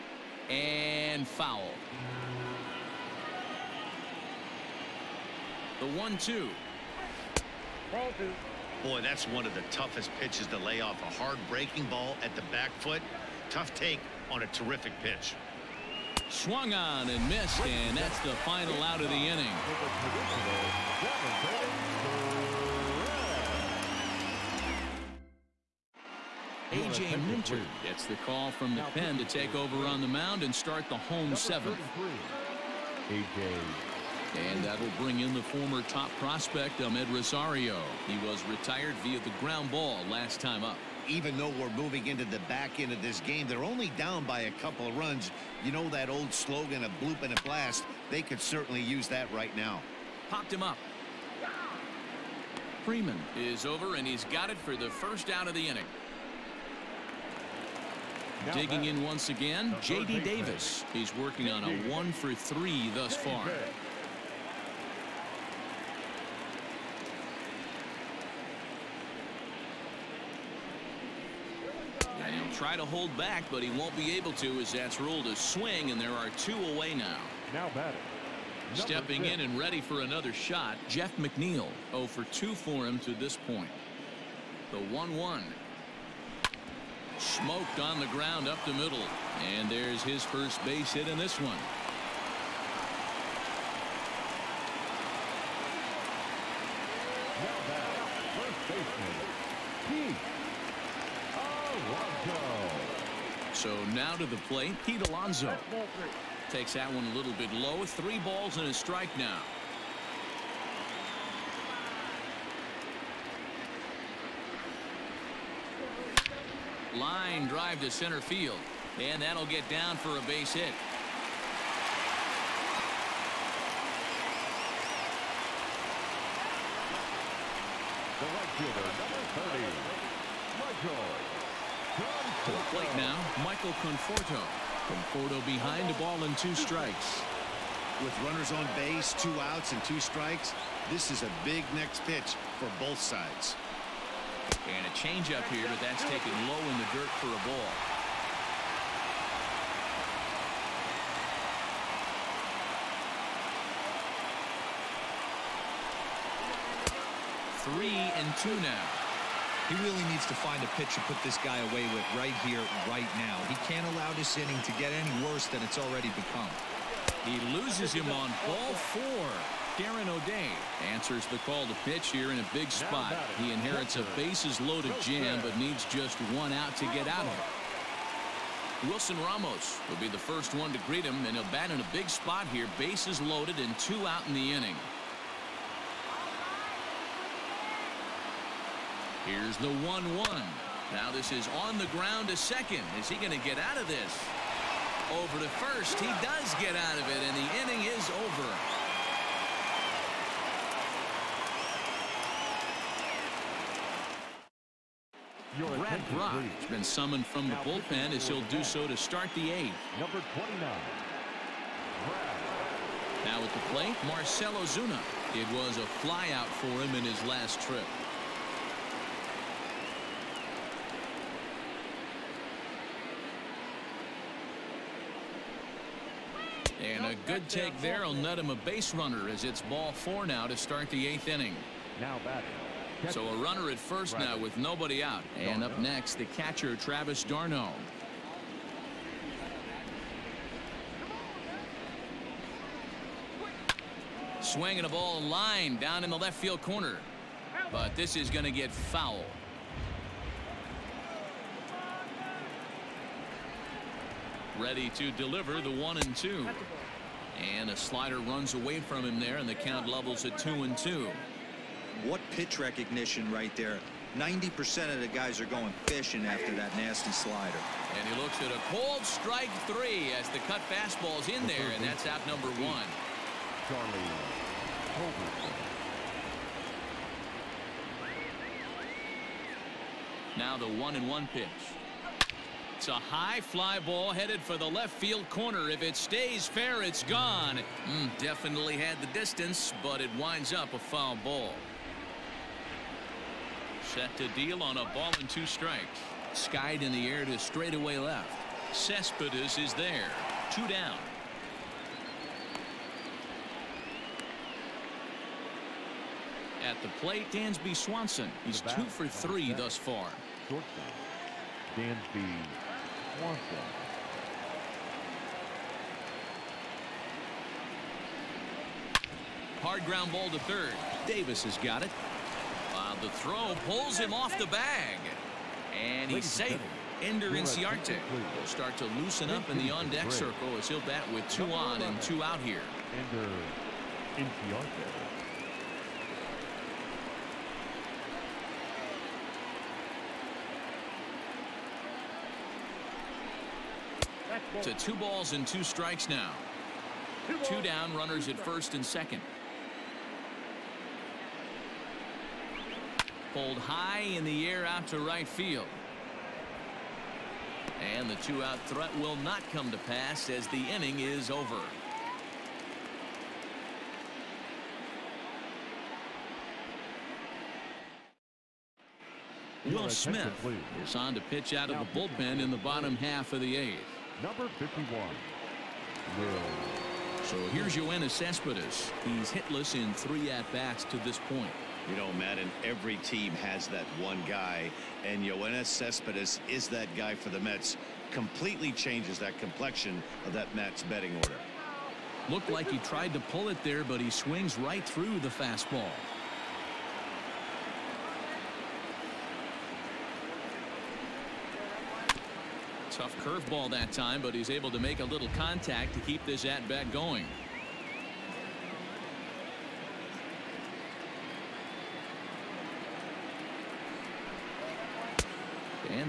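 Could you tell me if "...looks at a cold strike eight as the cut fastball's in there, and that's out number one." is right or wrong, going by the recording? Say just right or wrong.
wrong.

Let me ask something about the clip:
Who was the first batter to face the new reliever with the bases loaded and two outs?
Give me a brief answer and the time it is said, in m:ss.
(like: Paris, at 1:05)
Wilson Ramos, at 2:58.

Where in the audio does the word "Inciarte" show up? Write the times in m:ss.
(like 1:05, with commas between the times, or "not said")
5:27, 5:34.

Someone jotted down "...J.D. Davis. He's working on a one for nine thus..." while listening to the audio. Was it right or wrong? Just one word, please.
wrong.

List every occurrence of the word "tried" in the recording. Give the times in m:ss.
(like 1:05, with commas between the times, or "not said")
6:32.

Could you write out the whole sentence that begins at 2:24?
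And a changeup here, but that's taken low in the dirt for a ball.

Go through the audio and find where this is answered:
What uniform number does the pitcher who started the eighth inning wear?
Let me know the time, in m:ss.
3:29.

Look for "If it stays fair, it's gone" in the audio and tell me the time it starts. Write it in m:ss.
4:45.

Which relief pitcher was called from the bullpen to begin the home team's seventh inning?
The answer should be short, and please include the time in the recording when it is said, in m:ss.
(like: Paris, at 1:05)
A.J. Minter, at 0:26.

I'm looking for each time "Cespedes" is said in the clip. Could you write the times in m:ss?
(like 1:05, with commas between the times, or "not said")
4:58, 6:18, 6:25.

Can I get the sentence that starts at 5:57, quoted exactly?
And the two out threat will not come to pass as the inning is over.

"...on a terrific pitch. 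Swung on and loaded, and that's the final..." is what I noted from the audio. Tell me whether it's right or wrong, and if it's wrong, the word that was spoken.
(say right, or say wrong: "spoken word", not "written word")
wrong: "missed", not "loaded".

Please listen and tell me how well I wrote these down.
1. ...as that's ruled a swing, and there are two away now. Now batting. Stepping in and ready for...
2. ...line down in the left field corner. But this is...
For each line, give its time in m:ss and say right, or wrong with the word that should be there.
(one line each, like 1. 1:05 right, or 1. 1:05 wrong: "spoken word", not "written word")
1. 1:14 right
2. 4:05 right.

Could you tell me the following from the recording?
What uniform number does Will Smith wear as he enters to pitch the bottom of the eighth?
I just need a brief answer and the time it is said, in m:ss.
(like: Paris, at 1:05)
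51, at 6:14.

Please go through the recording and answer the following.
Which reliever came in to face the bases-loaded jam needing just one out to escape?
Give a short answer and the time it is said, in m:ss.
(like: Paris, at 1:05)
Darren O'Day, at 2:49.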